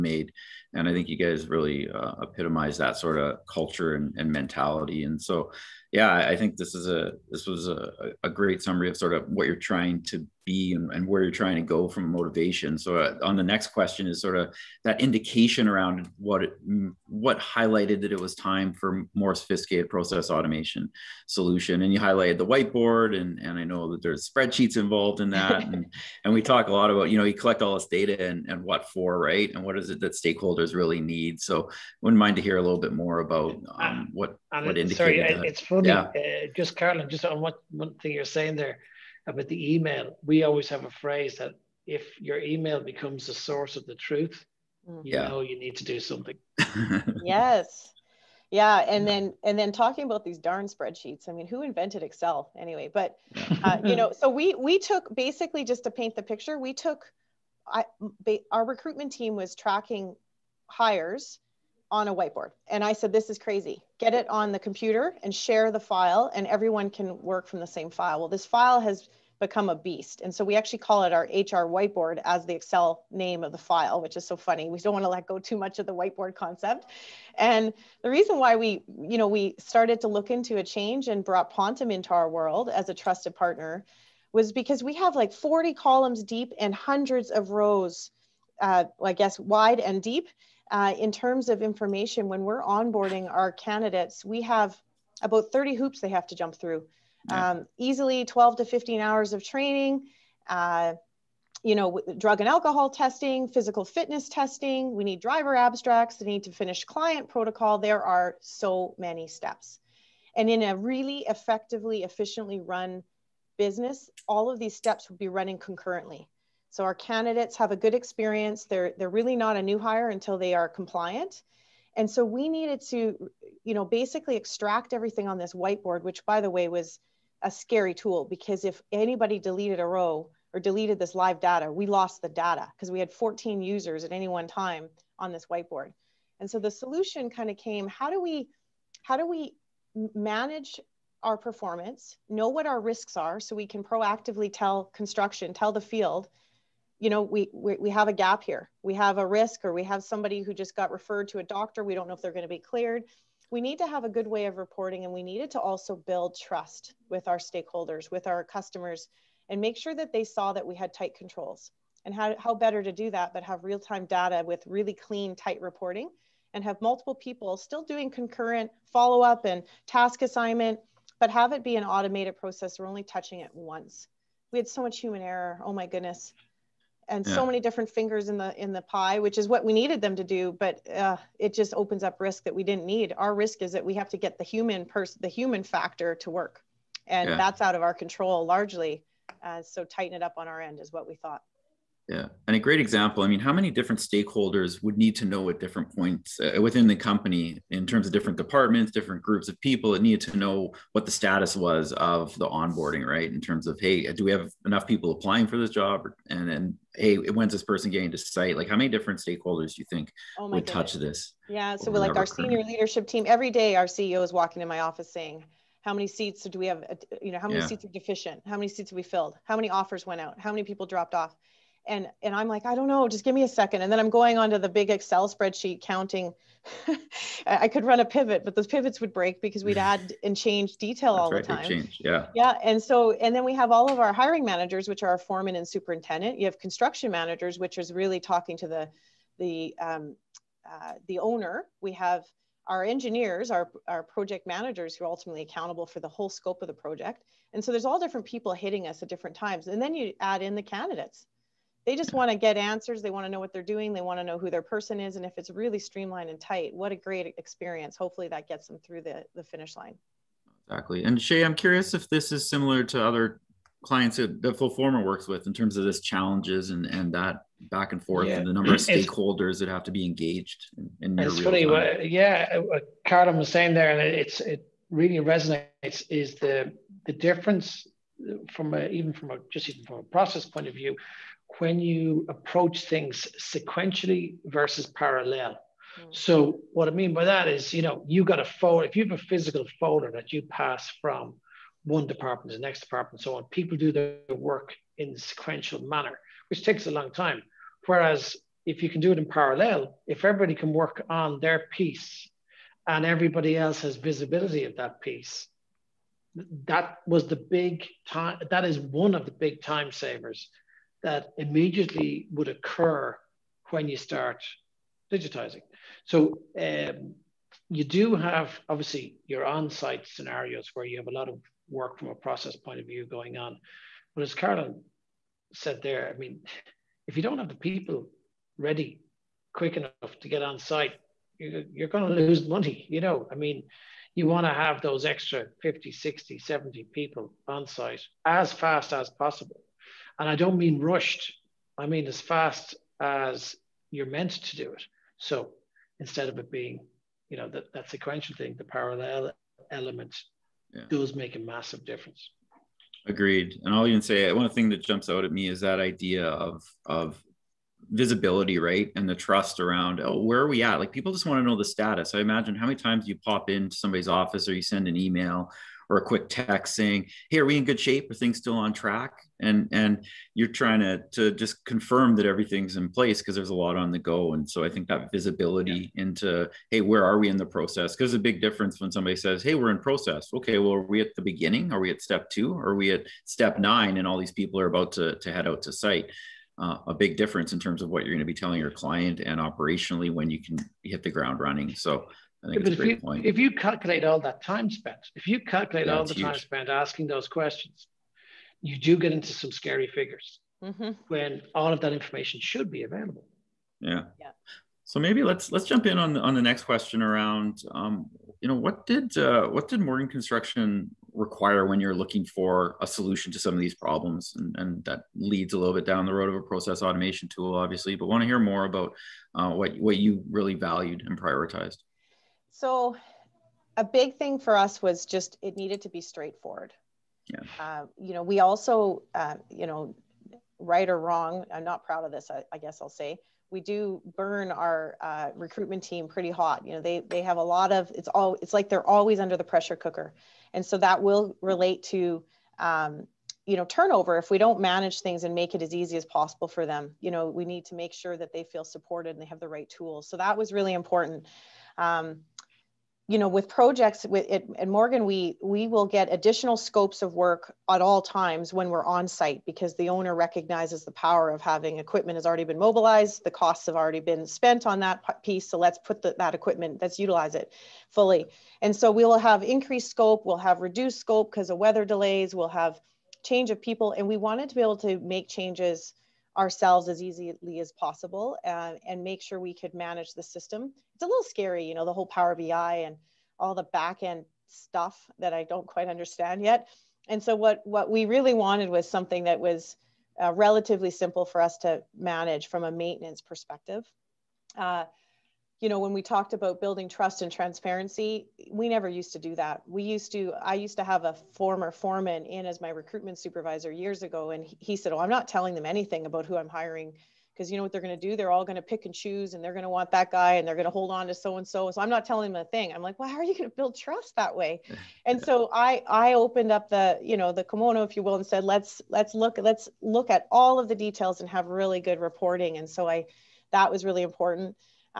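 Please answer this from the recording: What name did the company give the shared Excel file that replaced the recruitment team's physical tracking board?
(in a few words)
HR whiteboard.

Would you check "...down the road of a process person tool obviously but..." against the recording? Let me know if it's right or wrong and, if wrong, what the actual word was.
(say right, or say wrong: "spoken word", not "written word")
wrong: "automation", not "person".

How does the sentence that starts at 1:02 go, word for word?
And I said, this is crazy.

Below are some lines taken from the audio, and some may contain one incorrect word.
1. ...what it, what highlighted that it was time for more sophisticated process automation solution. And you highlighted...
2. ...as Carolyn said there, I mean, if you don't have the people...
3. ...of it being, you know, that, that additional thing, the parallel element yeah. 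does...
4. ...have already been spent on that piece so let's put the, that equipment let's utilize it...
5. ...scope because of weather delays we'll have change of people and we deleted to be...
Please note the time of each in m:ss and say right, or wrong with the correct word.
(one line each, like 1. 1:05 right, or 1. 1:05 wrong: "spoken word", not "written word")
1. 0:16 right
2. 5:24 right
3. 5:46 wrong: "sequential", not "additional"
4. 7:43 right
5. 7:50 wrong: "wanted", not "deleted".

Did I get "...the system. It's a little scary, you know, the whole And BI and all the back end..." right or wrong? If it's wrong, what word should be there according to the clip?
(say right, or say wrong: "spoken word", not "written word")
wrong: "Power", not "And".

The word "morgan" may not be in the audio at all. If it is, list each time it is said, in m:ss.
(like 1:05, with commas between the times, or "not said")
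6:49, 7:34.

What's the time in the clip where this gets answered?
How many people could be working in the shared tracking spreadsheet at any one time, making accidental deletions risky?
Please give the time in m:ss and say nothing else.
2:13.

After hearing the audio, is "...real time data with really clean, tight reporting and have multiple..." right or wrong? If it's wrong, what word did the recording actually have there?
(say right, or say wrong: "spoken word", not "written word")
right.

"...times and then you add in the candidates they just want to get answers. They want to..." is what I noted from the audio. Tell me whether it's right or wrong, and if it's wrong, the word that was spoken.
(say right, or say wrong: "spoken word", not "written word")
right.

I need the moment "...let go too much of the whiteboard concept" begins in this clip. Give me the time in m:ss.
1:15.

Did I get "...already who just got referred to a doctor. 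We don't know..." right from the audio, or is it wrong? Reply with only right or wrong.
wrong.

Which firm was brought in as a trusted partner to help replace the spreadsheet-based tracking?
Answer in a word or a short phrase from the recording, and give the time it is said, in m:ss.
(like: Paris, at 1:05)
Pontem, at 1:21.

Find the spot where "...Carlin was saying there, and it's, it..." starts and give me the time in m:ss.
4:33.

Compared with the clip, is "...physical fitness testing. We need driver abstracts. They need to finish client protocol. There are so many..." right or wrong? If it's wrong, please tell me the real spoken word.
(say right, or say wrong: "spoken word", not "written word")
right.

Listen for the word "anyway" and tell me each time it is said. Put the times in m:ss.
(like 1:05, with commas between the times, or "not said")
0:52.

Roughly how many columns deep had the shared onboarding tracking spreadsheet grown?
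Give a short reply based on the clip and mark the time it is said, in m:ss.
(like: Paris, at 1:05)
40, at 1:25.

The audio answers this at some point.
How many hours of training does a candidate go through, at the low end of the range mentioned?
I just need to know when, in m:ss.
1:38.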